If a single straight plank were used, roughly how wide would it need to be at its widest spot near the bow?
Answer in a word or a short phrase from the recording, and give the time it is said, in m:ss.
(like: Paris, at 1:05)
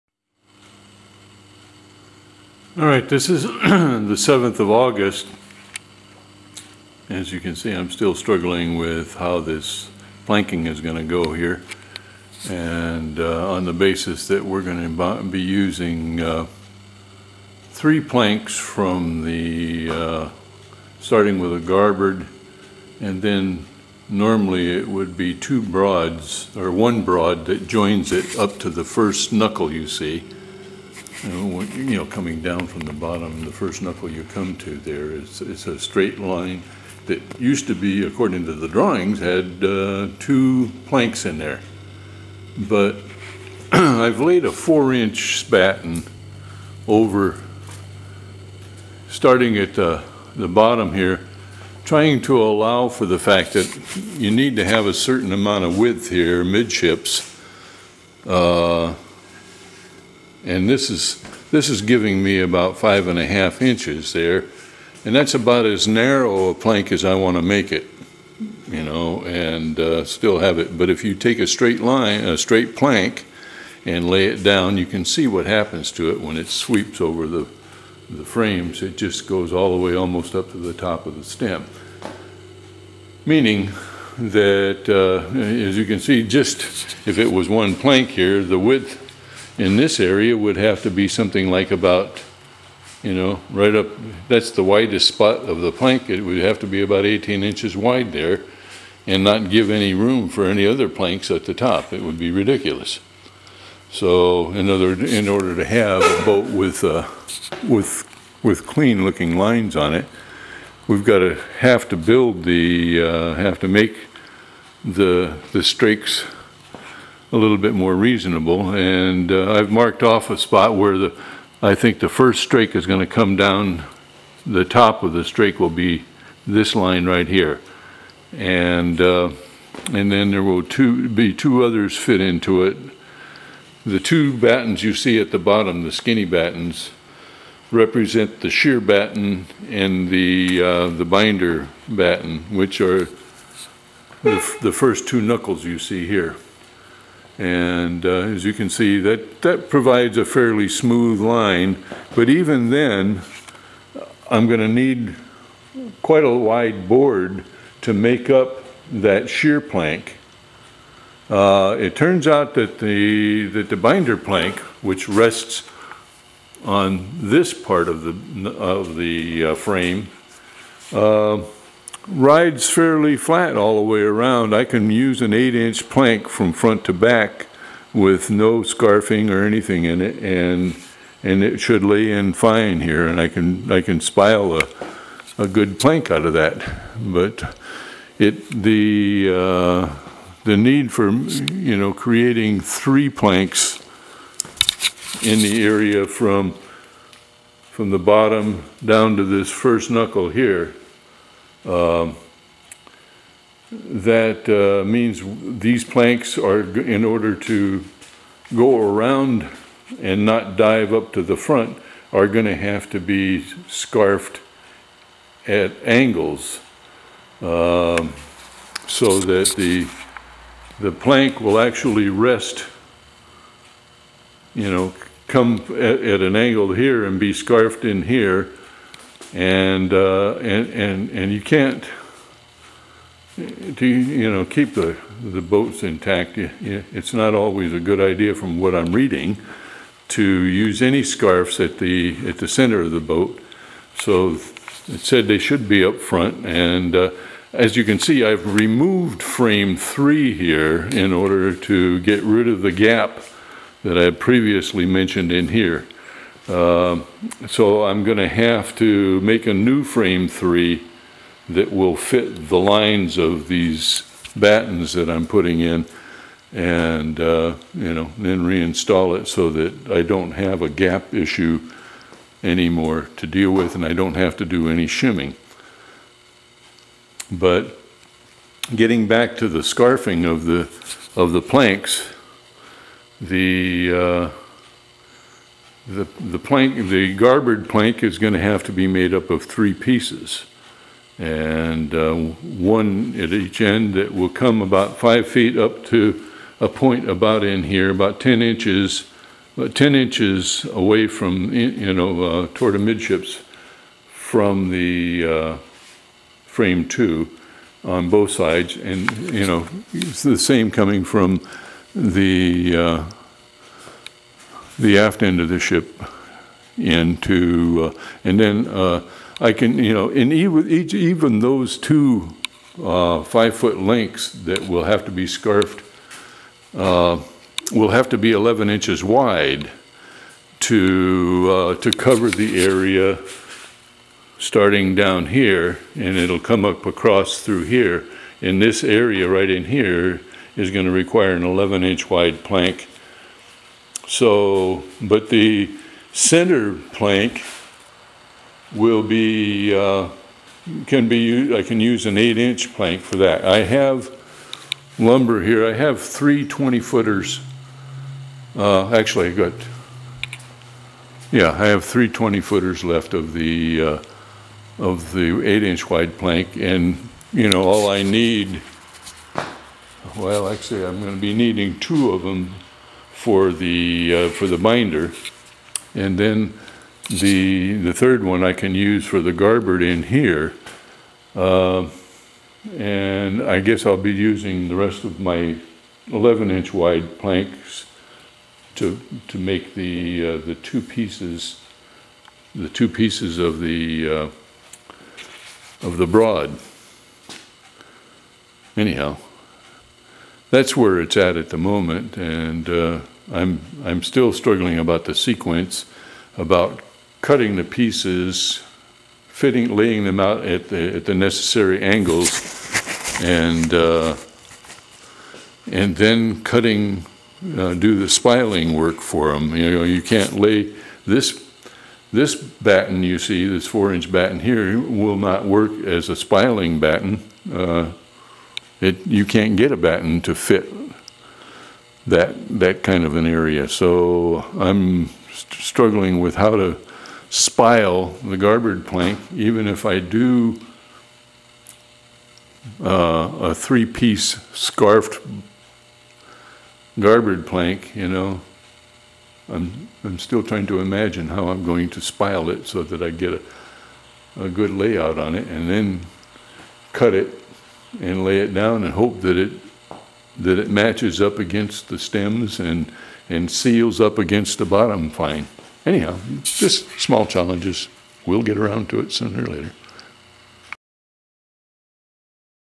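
18 inches, at 1:37.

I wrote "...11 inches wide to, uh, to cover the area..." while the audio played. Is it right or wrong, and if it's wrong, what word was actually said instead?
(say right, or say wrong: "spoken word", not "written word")
right.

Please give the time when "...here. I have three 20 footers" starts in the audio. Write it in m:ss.
5:55.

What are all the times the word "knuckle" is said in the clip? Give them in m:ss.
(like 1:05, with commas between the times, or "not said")
0:29, 0:33, 2:25, 3:19.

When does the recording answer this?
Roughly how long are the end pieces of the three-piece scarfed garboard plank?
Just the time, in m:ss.
4:54.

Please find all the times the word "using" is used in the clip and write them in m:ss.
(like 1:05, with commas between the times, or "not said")
0:15, 6:24.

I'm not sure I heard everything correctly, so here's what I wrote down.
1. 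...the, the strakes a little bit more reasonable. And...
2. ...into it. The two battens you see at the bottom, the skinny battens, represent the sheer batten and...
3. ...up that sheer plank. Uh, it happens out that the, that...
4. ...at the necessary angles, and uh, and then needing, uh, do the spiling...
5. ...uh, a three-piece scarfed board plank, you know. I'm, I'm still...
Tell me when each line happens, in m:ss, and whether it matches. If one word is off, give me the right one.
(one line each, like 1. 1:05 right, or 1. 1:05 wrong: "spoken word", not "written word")
1. 1:54 right
2. 2:12 right
3. 2:38 wrong: "turns", not "happens"
4. 6:50 wrong: "cutting", not "needing"
5. 7:22 wrong: "garboard", not "board".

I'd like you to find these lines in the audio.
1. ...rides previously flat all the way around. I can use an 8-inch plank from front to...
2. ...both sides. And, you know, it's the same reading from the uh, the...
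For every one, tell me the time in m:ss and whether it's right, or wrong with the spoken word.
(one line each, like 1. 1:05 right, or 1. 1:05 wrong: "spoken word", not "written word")
1. 2:52 wrong: "fairly", not "previously"
2. 5:08 wrong: "coming", not "reading".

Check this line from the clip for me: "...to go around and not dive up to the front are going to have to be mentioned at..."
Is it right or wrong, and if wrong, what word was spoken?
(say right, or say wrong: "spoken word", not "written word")
wrong: "scarfed", not "mentioned".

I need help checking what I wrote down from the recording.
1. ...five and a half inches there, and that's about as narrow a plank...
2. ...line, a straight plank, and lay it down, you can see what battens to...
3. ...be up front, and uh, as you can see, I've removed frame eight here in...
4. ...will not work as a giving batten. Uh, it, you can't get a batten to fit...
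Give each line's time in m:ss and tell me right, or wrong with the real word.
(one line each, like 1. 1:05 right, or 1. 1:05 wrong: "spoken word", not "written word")
1. 1:02 right
2. 1:11 wrong: "happens", not "battens"
3. 4:05 wrong: "three", not "eight"
4. 7:04 wrong: "spiling", not "giving".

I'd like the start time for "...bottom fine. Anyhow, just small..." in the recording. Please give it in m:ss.
7:44.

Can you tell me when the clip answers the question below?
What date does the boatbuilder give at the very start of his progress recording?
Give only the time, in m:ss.
0:03.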